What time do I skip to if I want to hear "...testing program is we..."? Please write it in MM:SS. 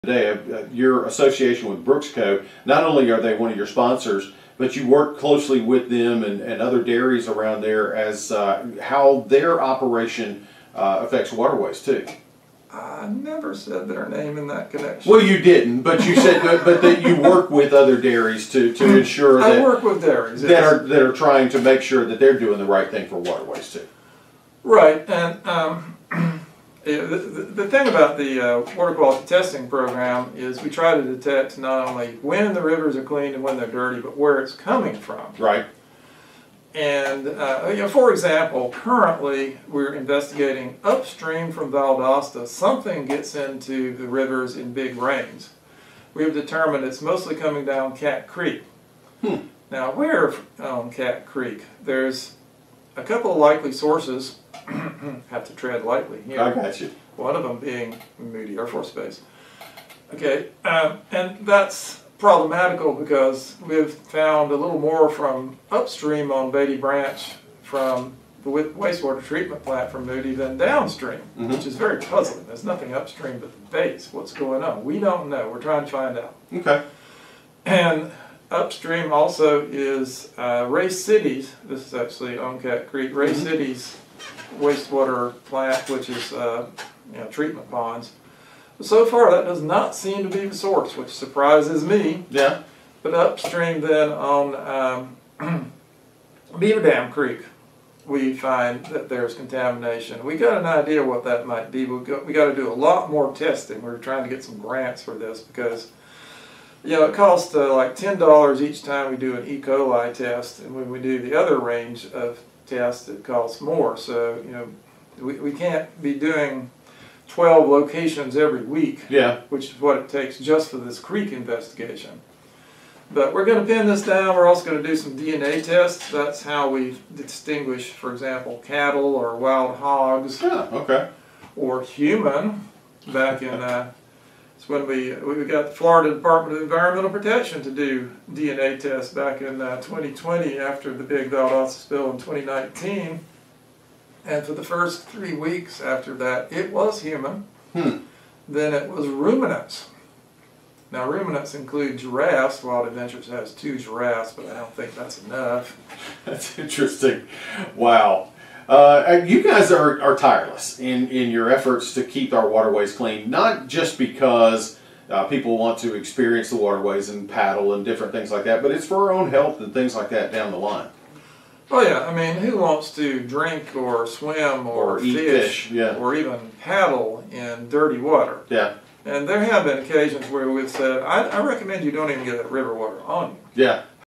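00:29.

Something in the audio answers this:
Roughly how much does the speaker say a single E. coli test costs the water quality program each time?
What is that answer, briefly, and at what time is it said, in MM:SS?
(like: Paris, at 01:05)
$10, at 01:47.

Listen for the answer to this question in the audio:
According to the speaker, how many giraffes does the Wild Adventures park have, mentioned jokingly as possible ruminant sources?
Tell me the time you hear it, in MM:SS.
02:33.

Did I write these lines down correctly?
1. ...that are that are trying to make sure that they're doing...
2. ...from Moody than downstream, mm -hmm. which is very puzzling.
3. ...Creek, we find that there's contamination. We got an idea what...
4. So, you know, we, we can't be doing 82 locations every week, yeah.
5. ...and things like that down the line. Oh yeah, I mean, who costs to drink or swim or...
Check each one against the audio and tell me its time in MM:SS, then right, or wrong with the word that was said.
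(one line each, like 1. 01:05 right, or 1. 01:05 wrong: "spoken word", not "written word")
1. 00:20 right
2. 01:09 right
3. 01:37 right
4. 01:53 wrong: "12", not "82"
5. 02:49 wrong: "wants", not "costs".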